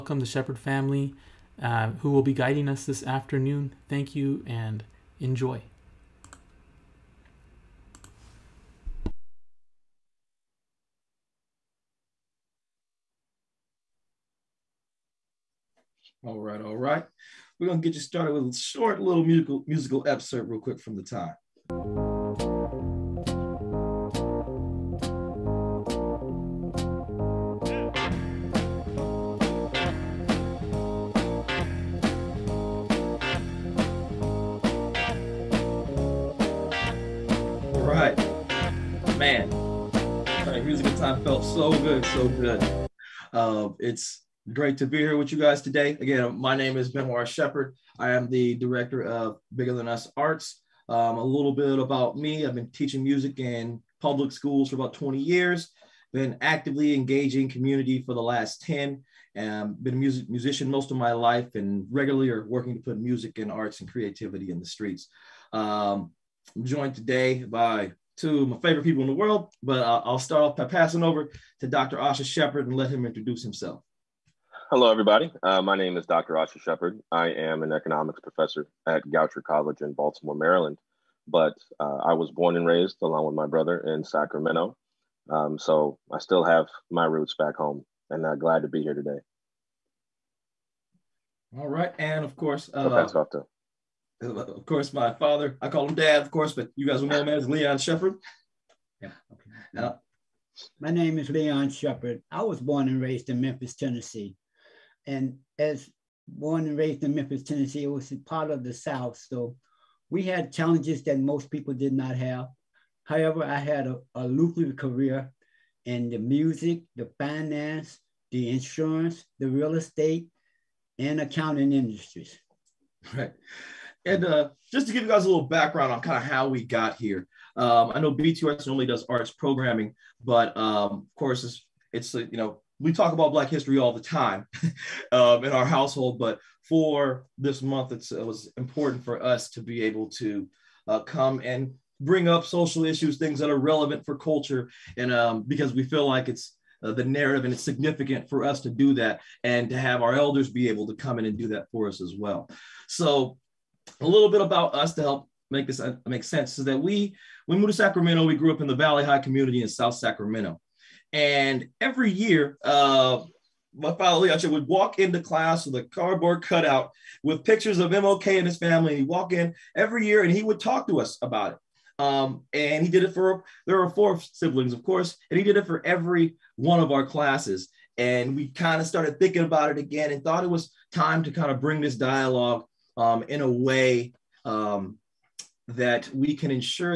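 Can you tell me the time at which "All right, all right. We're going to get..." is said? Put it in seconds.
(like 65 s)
16 s.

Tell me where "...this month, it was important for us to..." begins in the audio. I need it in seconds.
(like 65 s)
137 s.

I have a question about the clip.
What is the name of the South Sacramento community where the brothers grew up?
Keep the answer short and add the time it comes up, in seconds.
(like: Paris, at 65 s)
Valley High, at 158 s.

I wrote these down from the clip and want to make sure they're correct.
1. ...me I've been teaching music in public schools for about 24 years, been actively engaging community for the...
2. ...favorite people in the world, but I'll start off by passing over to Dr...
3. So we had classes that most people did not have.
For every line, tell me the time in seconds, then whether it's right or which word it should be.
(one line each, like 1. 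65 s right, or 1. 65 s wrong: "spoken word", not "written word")
1. 52 s wrong: "20", not "24"
2. 68 s right
3. 109 s wrong: "challenges", not "classes".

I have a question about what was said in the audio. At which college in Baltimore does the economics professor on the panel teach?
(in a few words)
Goucher College.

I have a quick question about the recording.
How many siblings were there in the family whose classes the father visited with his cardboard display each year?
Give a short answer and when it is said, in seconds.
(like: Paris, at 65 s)
4, at 173 s.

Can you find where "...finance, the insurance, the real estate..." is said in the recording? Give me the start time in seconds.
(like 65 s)
117 s.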